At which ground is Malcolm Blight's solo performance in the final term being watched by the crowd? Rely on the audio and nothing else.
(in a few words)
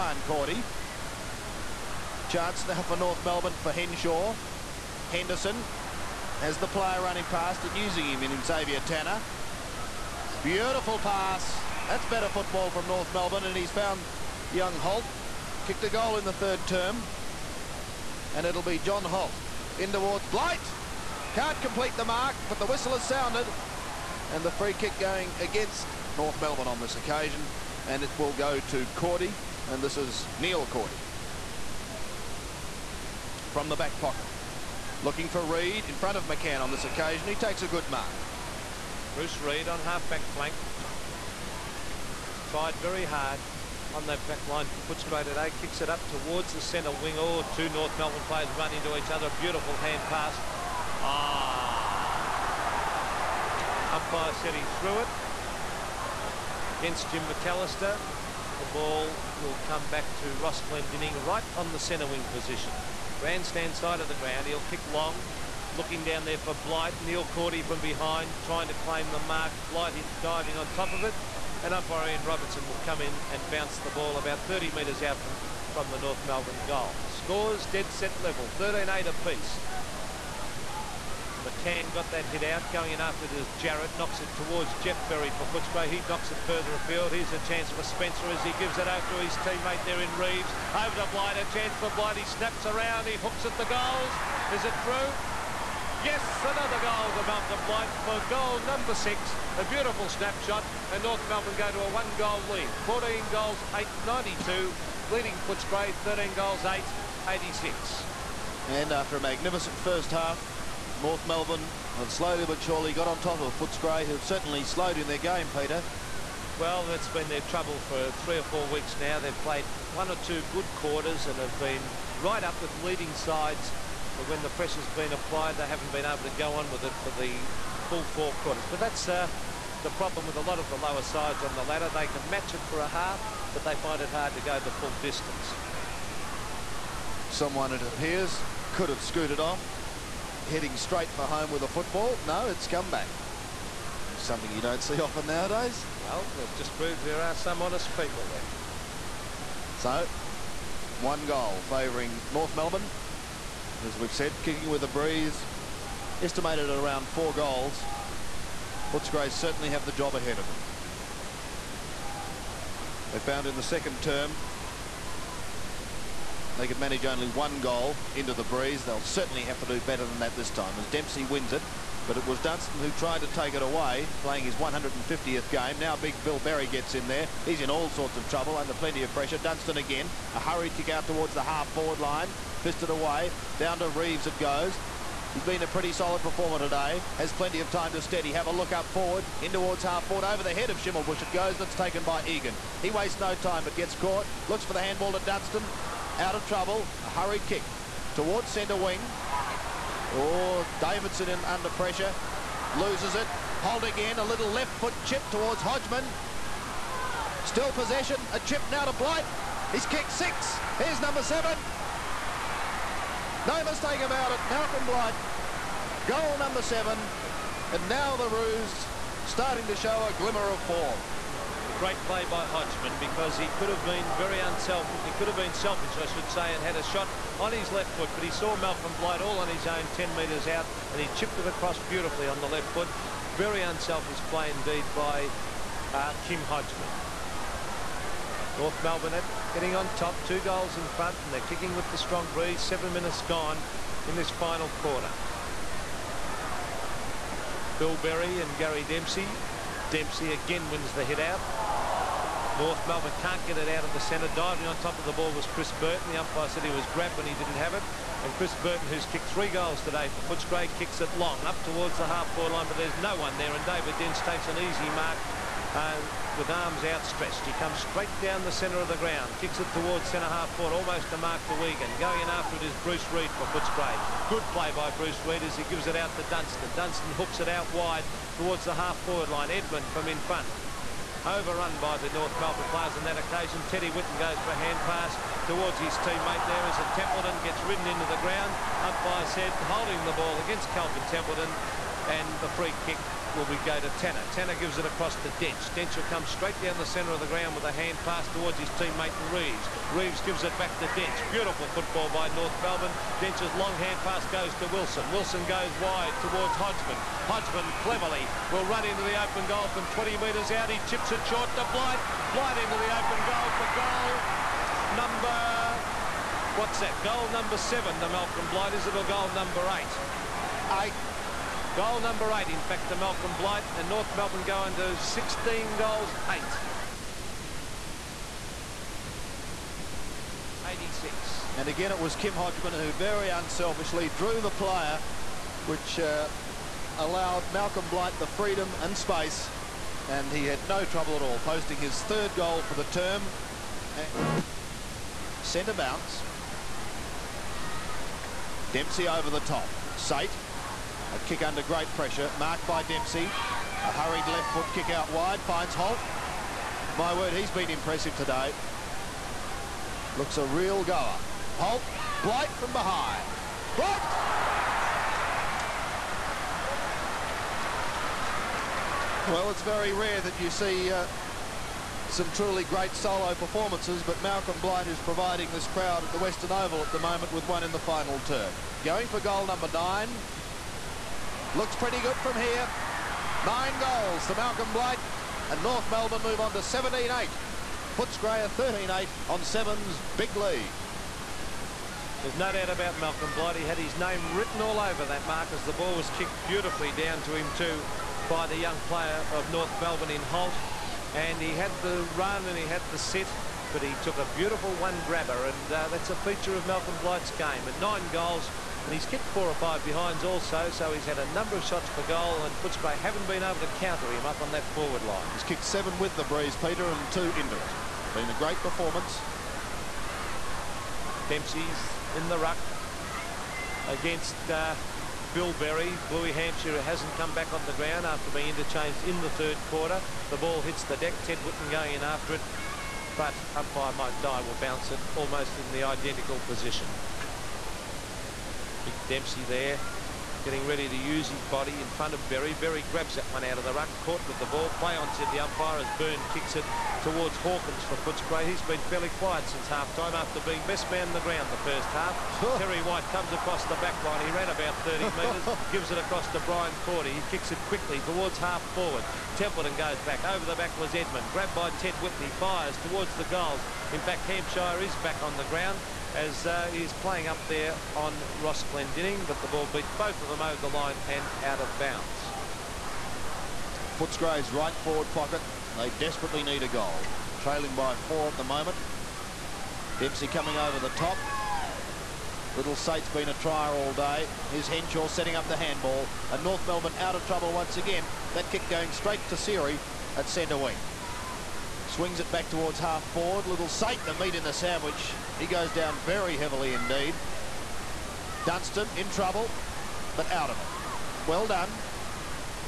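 Western Oval.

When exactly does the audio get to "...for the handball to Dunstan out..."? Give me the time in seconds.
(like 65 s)
194 s.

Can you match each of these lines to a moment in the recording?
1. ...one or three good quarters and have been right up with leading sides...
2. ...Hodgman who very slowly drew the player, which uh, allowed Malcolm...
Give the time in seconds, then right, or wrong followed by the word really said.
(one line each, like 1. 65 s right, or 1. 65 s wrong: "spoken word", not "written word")
1. 119 s wrong: "two", not "three"
2. 332 s wrong: "unselfishly", not "slowly".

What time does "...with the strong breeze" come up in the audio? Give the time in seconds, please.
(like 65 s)
241 s.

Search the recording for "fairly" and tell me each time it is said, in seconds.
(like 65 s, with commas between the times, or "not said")
448 s.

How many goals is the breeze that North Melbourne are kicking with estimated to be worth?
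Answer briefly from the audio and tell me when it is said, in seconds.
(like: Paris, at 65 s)
4 goals, at 157 s.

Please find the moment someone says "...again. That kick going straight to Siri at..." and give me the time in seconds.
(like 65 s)
487 s.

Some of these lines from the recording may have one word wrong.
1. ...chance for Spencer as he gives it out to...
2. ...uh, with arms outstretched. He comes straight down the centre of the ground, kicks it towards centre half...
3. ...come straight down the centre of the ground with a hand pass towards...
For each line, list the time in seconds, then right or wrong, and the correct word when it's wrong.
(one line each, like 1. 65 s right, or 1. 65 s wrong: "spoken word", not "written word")
1. 87 s right
2. 265 s right
3. 296 s right.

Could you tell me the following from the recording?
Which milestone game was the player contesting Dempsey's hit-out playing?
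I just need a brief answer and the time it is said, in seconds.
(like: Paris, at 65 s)
150th, at 174 s.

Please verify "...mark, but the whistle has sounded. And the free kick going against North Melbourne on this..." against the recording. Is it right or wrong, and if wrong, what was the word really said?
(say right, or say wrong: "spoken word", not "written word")
right.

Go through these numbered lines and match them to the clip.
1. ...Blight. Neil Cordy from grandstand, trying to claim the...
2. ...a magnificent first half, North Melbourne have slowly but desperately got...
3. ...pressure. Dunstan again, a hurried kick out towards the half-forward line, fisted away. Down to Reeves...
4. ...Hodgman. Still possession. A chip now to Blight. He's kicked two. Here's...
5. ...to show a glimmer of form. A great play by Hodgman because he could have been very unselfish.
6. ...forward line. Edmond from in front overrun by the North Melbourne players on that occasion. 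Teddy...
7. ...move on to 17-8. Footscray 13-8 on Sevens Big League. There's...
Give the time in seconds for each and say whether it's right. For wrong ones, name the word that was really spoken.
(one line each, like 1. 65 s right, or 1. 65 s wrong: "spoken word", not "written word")
1. 66 s wrong: "behind", not "grandstand"
2. 109 s wrong: "surely", not "desperately"
3. 179 s right
4. 205 s wrong: "six", not "two"
5. 219 s right
6. 279 s right
7. 386 s right.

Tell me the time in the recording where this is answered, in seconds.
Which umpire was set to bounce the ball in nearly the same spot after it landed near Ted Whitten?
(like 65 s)
433 s.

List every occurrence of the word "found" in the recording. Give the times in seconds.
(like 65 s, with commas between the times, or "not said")
13 s, 163 s.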